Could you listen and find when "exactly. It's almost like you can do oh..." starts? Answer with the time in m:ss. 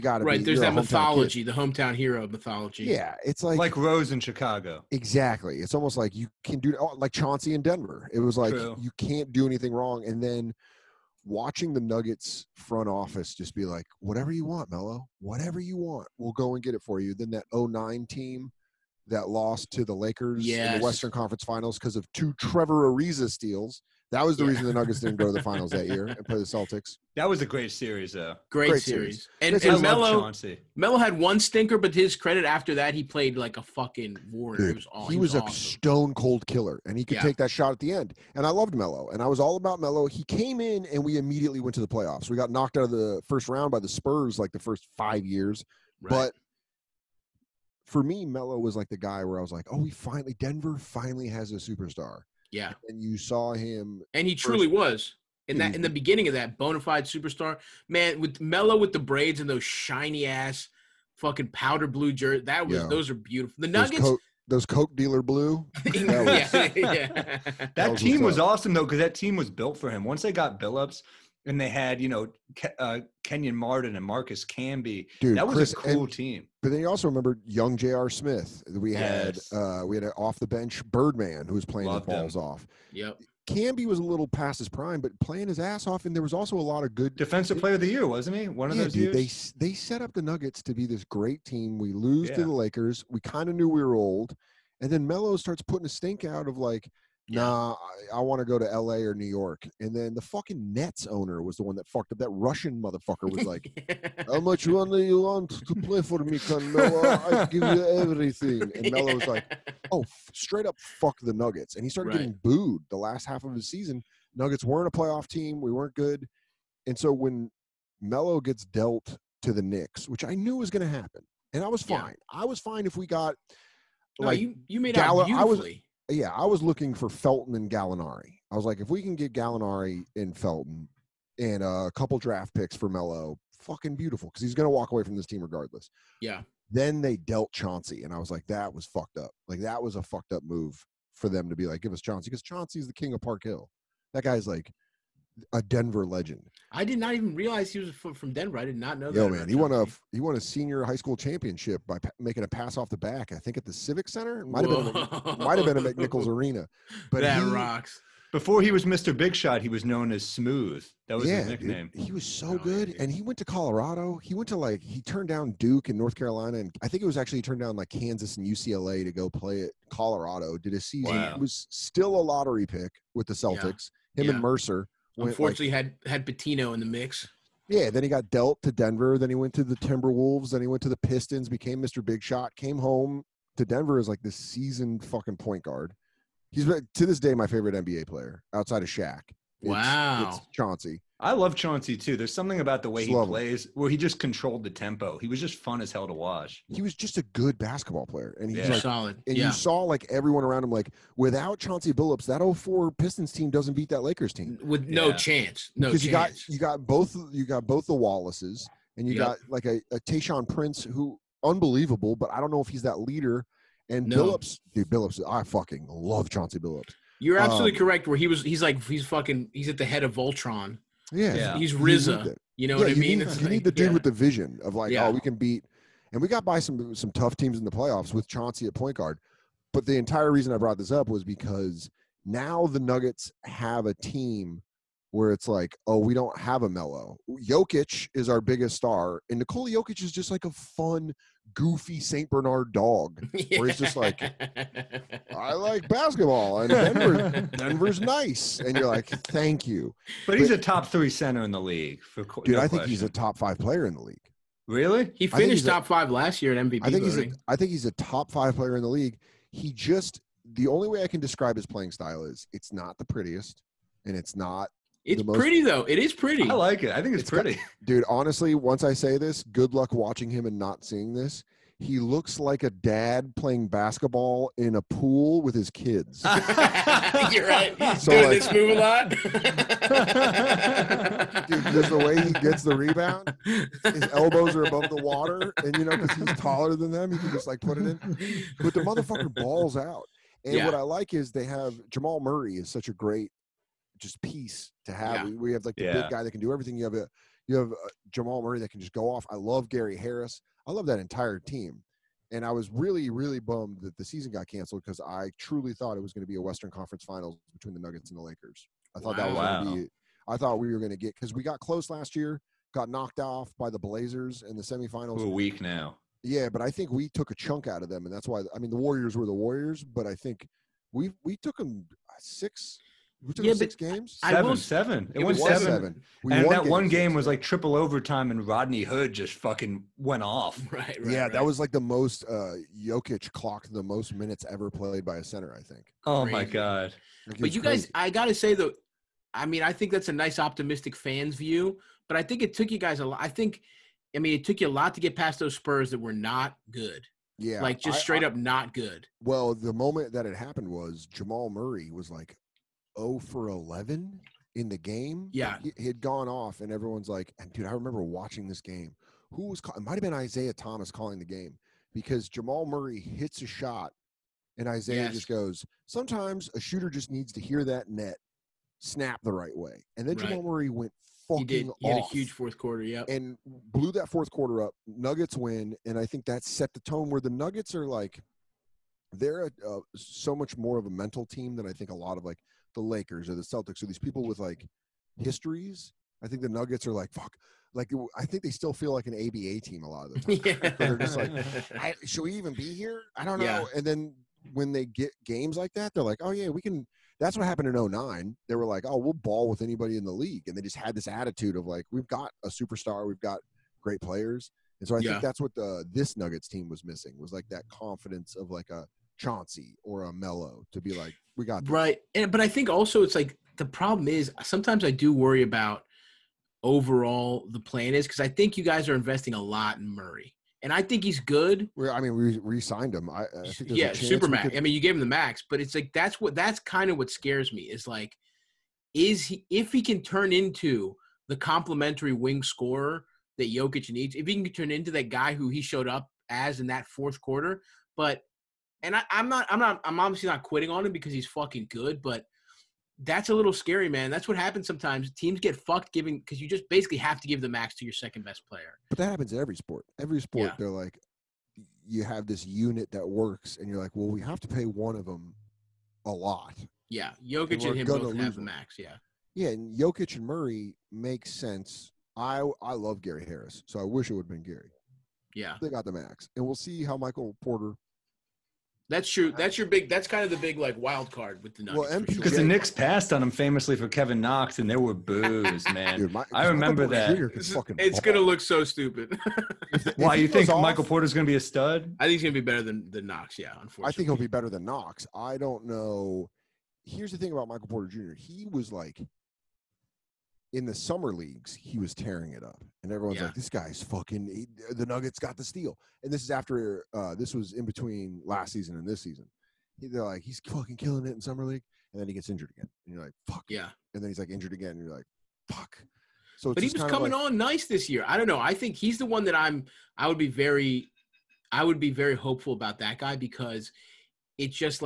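0:04.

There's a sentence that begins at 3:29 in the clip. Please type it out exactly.
got like a, a Tayshaun Prince who unbelievable, but I don't know if he's that leader.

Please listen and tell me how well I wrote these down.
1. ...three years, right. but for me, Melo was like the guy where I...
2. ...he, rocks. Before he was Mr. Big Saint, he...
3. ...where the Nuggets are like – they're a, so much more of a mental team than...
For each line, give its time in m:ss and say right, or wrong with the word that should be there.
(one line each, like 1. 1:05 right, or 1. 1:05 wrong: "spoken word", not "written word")
1. 0:44 wrong: "five", not "three"
2. 2:37 wrong: "Shot", not "Saint"
3. 6:17 right.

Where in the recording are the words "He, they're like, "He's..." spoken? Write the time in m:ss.
8:19.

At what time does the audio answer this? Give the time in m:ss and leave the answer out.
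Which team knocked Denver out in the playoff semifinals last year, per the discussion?
5:13.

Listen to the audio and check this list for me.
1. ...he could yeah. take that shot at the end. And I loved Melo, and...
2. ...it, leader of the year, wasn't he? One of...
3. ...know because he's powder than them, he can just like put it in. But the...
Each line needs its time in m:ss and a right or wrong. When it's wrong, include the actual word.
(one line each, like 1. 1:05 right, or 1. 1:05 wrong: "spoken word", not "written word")
1. 0:36 right
2. 1:27 wrong: "player", not "leader"
3. 4:45 wrong: "taller", not "powder".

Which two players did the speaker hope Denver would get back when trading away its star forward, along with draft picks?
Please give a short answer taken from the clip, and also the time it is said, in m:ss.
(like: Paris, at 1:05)
Felton and Gallinari, at 2:07.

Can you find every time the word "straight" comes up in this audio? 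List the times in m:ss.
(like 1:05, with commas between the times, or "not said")
1:50, 5:48.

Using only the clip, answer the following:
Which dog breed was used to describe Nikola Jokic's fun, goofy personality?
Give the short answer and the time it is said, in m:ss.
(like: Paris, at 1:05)
Saint Bernard, at 4:01.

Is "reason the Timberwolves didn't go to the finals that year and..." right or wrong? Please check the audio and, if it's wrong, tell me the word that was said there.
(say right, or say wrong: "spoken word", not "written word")
wrong: "Nuggets", not "Timberwolves".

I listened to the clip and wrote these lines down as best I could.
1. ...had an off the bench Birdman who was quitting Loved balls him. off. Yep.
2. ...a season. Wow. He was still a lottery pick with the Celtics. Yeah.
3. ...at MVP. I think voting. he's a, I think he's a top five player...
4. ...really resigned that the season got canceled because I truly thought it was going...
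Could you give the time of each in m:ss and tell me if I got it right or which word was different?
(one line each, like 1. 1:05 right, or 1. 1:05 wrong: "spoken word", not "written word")
1. 1:19 wrong: "playing", not "quitting"
2. 2:50 right
3. 4:16 right
4. 5:03 wrong: "bummed", not "resigned".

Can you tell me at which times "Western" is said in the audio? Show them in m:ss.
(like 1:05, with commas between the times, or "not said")
0:20, 5:06.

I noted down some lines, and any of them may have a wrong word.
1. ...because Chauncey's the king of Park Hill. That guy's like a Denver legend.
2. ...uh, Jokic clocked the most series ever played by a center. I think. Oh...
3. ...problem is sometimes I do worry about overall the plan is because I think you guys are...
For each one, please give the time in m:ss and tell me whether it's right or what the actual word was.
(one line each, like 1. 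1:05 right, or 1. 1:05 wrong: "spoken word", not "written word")
1. 2:22 right
2. 5:32 wrong: "minutes", not "series"
3. 6:53 right.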